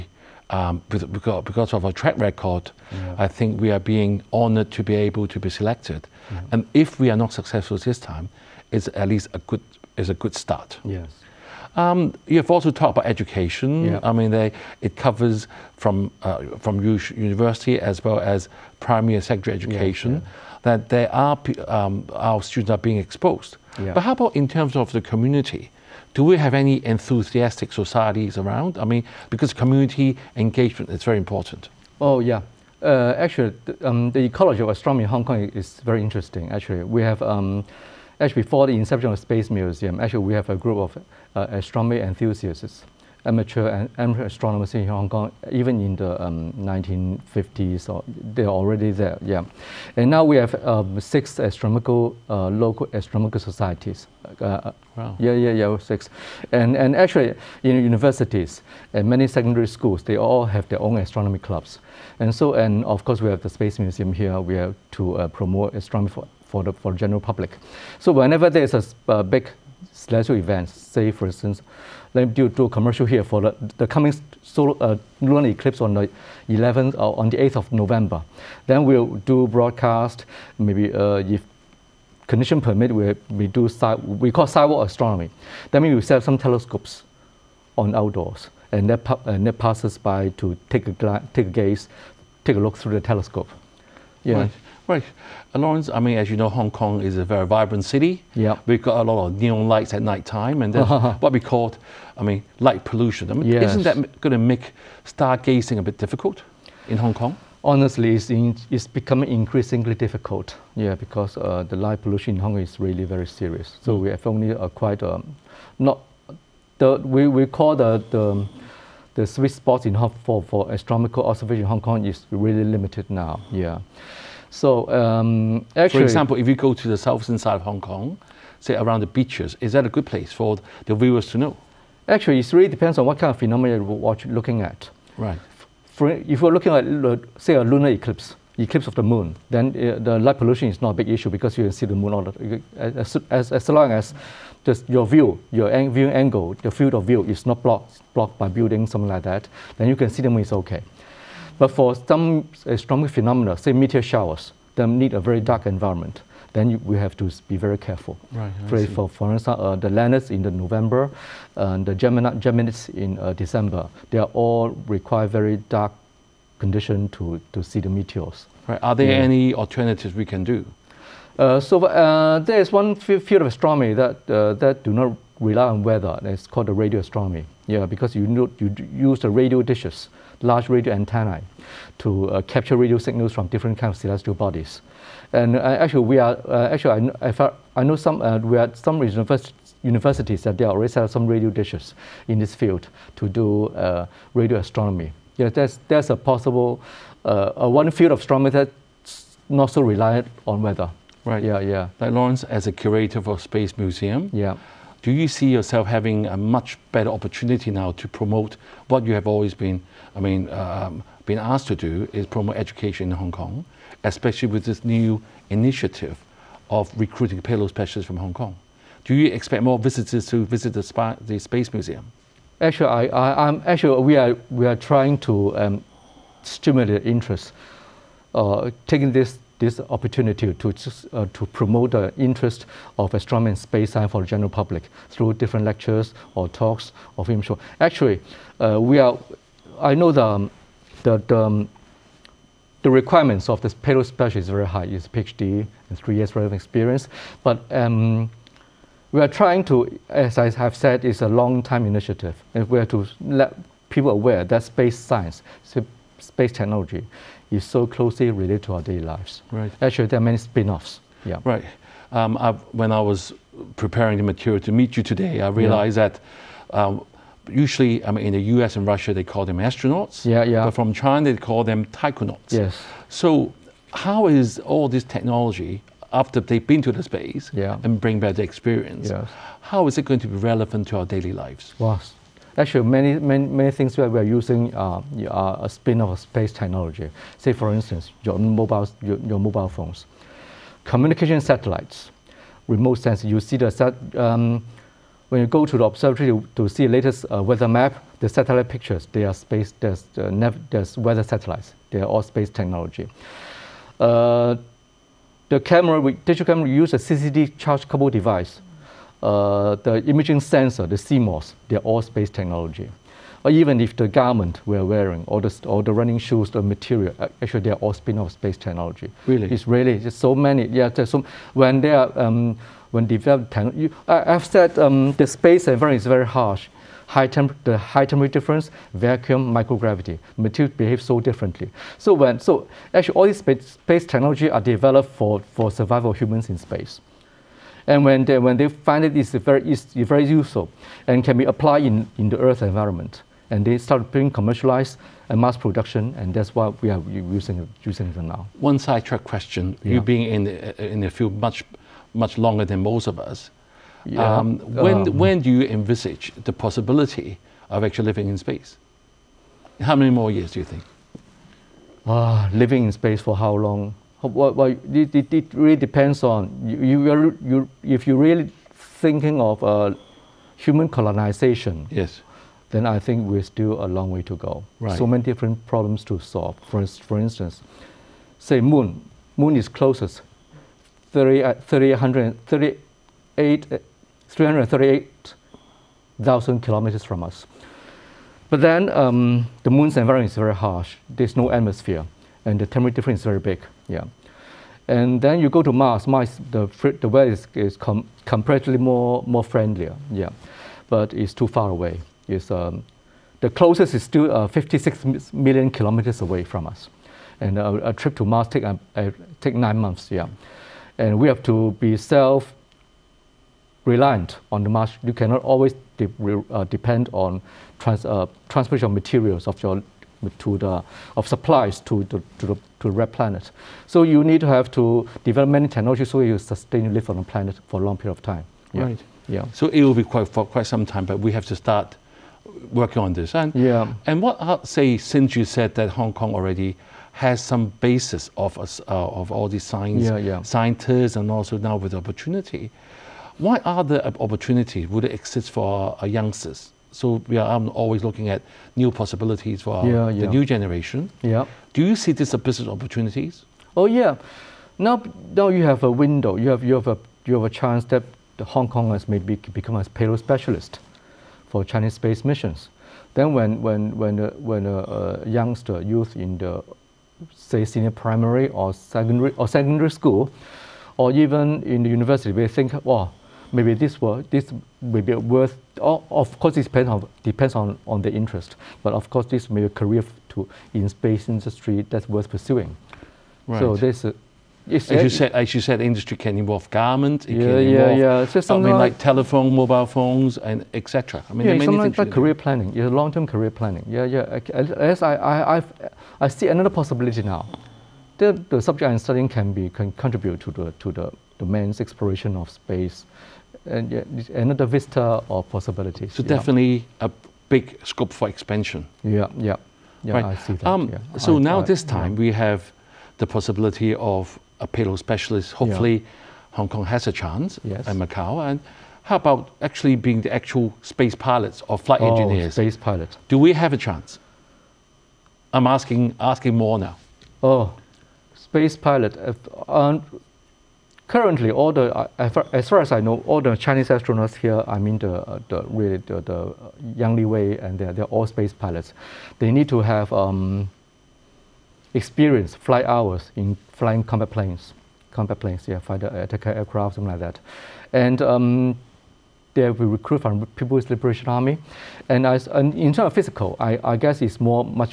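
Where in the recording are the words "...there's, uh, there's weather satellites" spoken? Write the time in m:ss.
4:59.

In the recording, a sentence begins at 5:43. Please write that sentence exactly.
And they start being commercialized and mass production, and that's why we are using, using them now.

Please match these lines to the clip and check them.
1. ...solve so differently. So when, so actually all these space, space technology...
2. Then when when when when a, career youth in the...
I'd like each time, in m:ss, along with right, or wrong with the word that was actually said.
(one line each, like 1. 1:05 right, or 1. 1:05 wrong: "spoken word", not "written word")
1. 5:30 wrong: "behave", not "solve"
2. 7:43 wrong: "youngster", not "career".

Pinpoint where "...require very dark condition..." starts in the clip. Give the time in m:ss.
2:44.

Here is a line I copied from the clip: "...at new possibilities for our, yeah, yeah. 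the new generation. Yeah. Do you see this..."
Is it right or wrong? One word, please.
right.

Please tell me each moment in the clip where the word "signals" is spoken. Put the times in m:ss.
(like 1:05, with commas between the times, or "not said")
3:02.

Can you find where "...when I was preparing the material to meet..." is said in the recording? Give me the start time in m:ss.
4:22.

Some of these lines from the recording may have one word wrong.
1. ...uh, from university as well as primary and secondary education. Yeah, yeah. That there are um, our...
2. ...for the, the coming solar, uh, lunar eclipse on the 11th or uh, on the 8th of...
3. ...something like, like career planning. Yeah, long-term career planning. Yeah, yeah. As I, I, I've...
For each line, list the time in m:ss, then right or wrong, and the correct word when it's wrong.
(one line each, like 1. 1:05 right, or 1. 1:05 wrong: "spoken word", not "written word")
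1. 0:16 right
2. 1:13 right
3. 8:11 right.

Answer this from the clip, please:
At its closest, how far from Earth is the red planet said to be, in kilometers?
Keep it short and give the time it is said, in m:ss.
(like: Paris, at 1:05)
56 million, at 6:44.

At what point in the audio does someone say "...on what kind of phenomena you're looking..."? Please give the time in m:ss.
2:12.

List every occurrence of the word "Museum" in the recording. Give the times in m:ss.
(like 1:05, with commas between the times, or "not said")
0:39, 1:03, 3:23, 3:41.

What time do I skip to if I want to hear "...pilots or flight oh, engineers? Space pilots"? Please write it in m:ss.
8:41.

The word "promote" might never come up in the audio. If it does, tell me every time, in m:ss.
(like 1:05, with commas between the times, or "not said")
1:05, 3:28, 3:32, 3:51.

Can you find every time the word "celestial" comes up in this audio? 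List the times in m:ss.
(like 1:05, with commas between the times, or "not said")
1:09, 3:04.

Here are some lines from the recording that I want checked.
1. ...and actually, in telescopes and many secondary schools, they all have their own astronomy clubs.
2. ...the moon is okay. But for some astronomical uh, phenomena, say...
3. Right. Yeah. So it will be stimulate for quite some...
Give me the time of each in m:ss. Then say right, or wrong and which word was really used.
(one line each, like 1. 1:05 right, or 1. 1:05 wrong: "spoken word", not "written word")
1. 0:56 wrong: "universities", not "telescopes"
2. 2:30 right
3. 7:08 wrong: "quite", not "stimulate".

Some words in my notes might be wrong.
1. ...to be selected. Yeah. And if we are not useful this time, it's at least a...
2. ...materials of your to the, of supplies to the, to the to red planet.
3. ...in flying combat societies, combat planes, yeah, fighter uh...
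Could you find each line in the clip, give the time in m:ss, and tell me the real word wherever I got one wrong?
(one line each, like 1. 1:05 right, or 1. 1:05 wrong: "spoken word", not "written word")
1. 0:05 wrong: "successful", not "useful"
2. 6:58 right
3. 9:03 wrong: "planes", not "societies".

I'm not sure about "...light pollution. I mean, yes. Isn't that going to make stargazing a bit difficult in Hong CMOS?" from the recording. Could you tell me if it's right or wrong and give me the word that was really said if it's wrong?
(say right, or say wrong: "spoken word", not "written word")
wrong: "Kong", not "CMOS".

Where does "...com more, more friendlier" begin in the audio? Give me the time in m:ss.
6:37.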